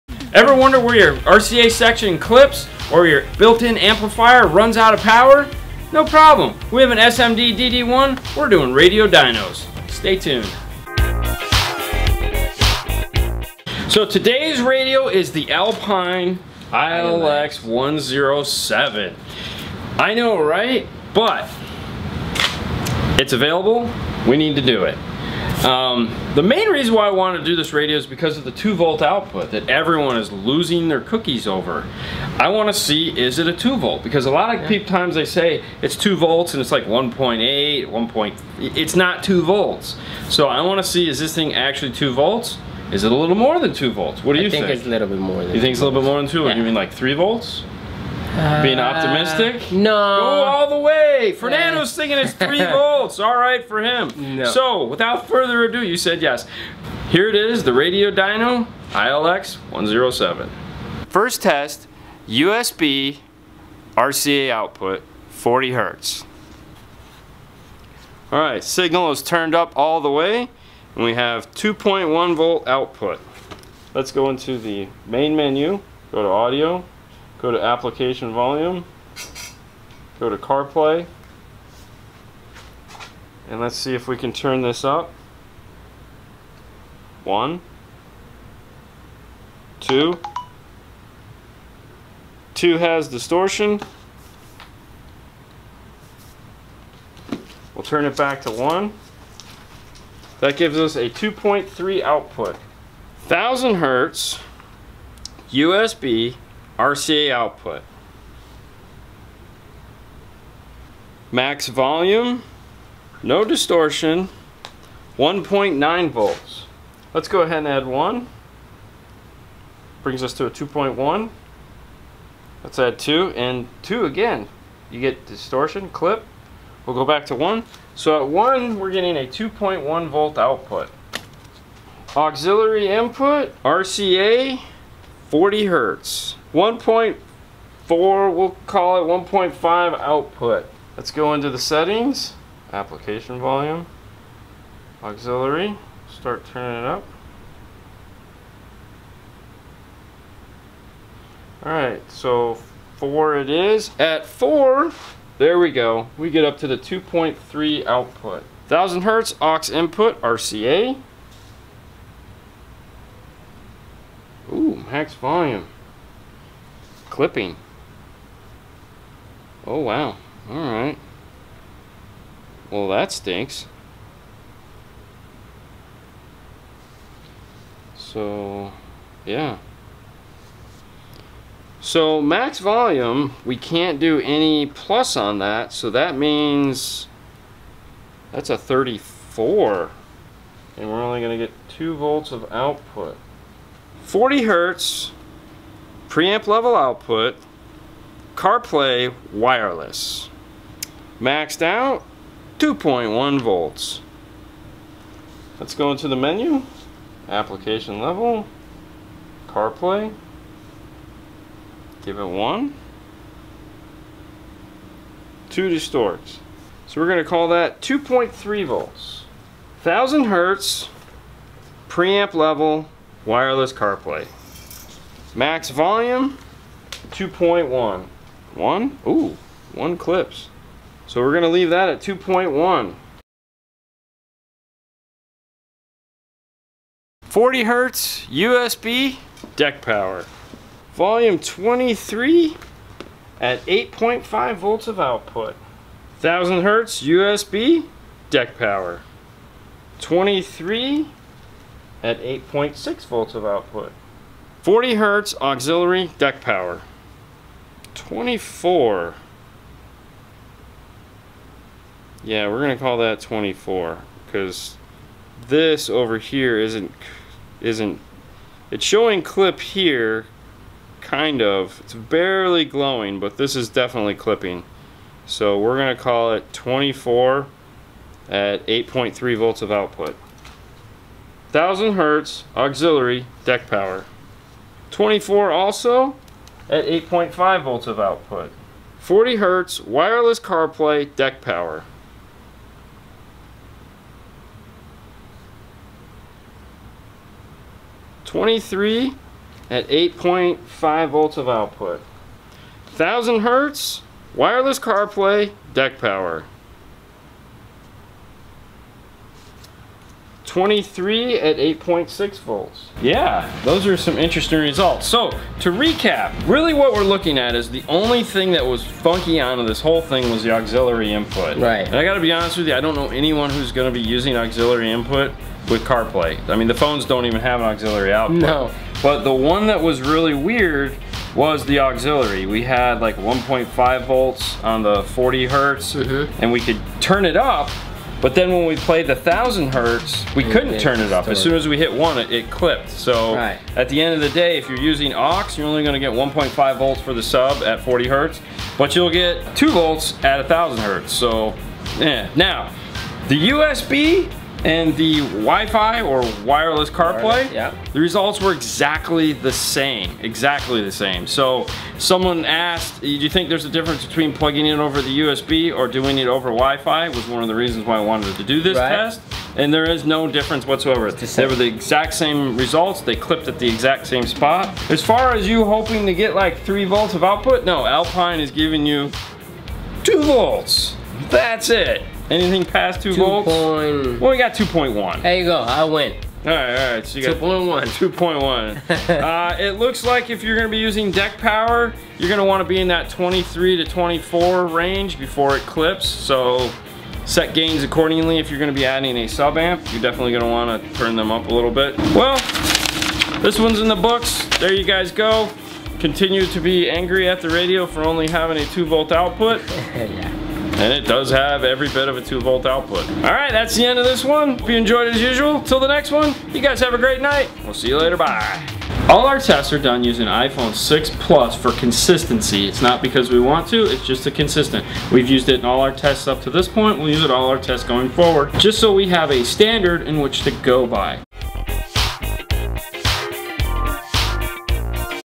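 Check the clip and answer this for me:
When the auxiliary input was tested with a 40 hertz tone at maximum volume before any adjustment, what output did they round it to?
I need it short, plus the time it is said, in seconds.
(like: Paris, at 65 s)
1.5 volts, at 138 s.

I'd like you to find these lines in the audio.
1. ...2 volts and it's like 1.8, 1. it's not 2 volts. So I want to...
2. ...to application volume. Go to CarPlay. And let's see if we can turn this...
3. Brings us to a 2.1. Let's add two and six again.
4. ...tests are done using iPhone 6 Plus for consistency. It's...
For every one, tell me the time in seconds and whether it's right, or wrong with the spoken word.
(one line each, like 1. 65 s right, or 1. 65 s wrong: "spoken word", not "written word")
1. 35 s right
2. 77 s right
3. 120 s wrong: "two", not "six"
4. 419 s right.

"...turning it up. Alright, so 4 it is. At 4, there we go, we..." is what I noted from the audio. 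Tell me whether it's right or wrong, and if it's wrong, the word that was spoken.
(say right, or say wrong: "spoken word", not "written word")
right.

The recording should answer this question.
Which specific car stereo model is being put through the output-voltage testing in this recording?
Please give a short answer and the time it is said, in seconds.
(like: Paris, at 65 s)
Alpine ILX 107, at 15 s.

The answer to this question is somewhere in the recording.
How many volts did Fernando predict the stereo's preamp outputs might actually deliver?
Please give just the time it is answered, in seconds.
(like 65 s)
46 s.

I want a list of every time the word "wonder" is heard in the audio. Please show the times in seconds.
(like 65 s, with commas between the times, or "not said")
0 s.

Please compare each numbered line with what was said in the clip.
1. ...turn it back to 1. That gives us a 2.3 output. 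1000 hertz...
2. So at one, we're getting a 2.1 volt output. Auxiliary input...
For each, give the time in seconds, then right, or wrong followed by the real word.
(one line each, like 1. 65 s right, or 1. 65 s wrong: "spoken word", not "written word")
1. 97 s right
2. 127 s right.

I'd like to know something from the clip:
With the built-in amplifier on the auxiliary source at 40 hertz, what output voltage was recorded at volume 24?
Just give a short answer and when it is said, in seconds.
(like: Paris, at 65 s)
8.3 volts, at 278 s.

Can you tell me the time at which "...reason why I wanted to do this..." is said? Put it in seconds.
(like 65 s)
26 s.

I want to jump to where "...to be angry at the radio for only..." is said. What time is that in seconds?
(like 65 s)
406 s.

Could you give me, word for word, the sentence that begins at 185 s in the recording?
So that means that's a 34.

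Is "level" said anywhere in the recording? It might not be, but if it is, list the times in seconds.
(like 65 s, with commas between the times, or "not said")
196 s, 208 s, 222 s.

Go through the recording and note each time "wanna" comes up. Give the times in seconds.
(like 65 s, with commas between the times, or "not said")
392 s, 400 s.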